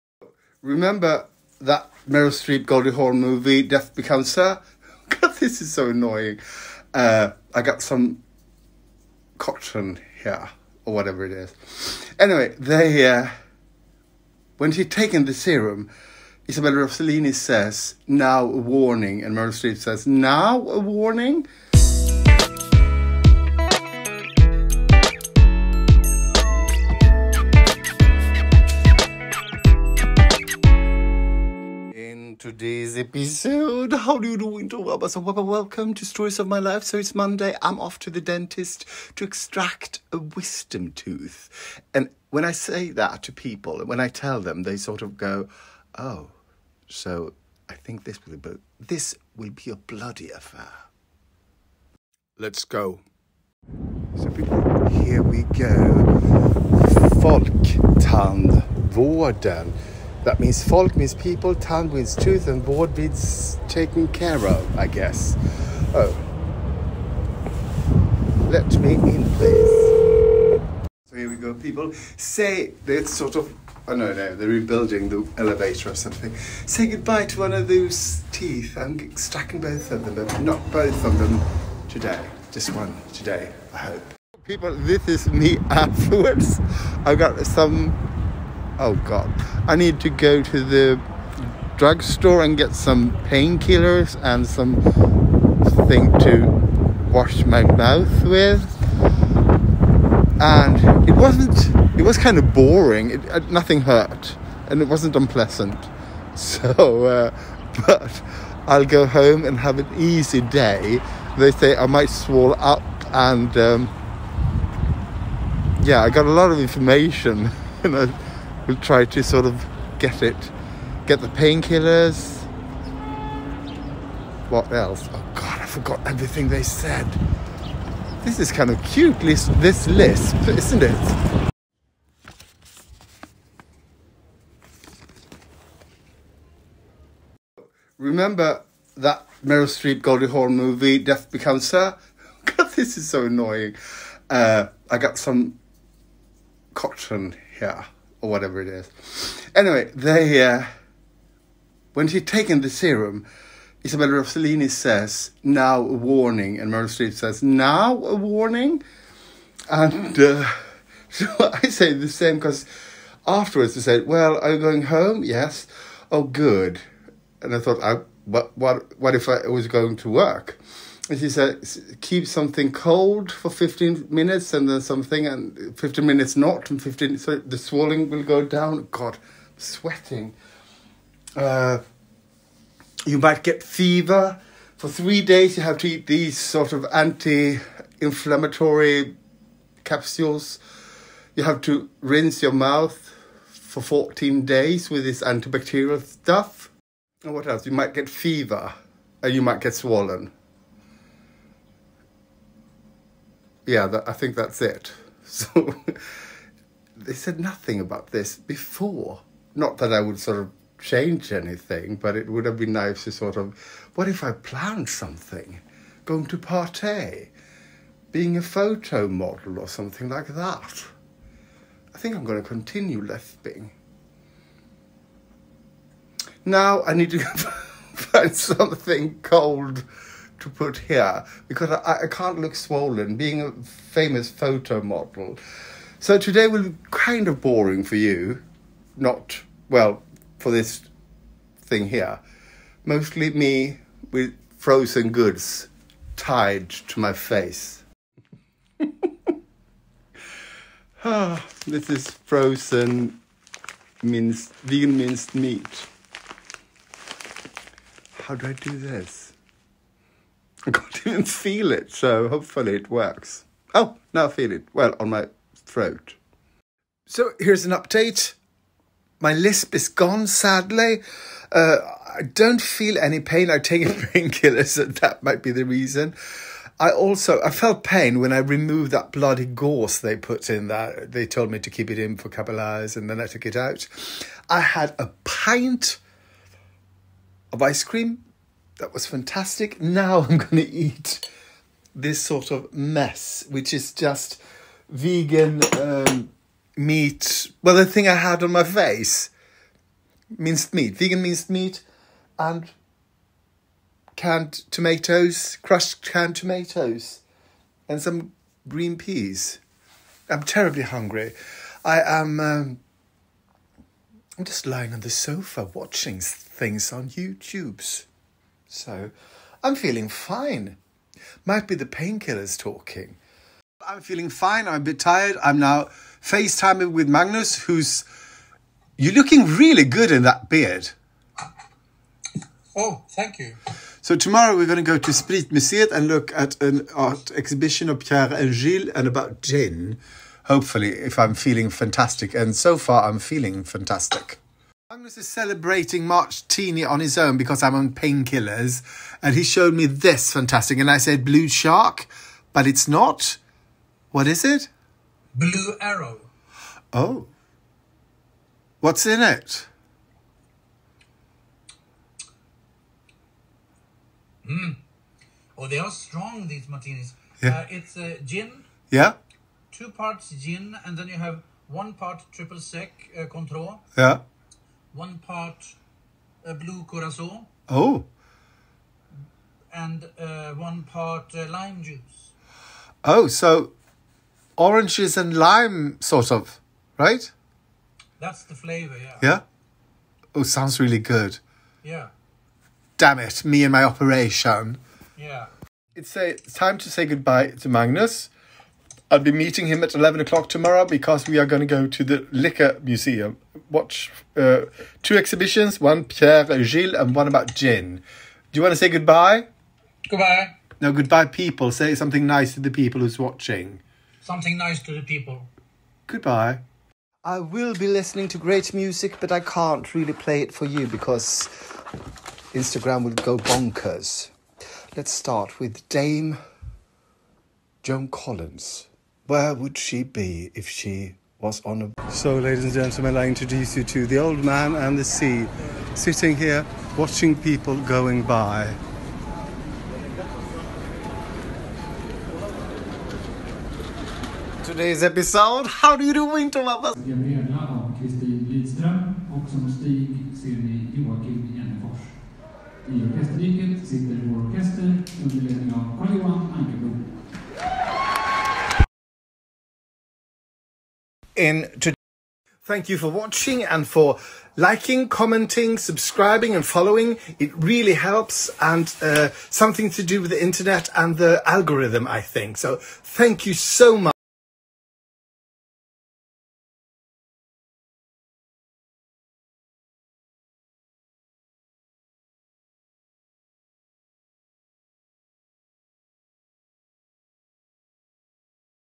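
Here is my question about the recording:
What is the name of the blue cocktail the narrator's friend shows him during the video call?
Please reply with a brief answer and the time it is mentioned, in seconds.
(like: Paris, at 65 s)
Blue arrow, at 355 s.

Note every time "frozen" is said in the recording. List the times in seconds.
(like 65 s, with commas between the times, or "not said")
244 s, 252 s.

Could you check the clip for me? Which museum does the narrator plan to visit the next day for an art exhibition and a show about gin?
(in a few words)
Spritmuseet.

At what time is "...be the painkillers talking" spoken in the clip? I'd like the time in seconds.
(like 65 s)
321 s.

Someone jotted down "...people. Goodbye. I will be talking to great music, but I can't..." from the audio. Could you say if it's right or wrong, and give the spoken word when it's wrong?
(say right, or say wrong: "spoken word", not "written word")
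wrong: "listening", not "talking".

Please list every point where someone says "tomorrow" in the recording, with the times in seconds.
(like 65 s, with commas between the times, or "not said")
334 s, 400 s.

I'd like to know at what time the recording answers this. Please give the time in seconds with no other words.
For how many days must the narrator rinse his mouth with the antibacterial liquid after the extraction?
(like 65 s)
193 s.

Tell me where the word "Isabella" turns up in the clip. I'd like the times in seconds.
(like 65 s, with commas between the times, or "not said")
16 s, 153 s.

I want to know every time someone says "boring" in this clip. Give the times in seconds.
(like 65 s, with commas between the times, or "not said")
102 s, 237 s.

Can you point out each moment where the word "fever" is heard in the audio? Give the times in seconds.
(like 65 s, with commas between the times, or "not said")
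183 s, 198 s.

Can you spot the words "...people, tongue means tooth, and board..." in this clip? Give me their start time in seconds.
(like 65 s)
61 s.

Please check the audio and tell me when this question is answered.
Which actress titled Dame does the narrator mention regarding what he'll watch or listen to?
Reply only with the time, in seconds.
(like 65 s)
427 s.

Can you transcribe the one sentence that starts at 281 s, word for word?
They told me to keep it in for a couple of hours, and then I took it out.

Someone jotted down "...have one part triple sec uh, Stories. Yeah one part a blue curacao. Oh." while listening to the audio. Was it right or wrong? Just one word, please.
wrong.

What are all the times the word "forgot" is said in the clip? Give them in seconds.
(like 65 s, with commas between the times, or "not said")
125 s.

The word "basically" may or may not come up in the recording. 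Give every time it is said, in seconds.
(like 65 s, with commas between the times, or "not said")
not said.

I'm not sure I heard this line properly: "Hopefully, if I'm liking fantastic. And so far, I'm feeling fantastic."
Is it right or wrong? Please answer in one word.
wrong.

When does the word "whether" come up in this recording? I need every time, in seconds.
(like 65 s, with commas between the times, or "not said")
not said.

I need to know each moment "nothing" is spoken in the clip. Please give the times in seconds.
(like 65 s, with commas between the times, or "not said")
103 s, 207 s.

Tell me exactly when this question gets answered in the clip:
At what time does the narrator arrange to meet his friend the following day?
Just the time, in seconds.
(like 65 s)
399 s.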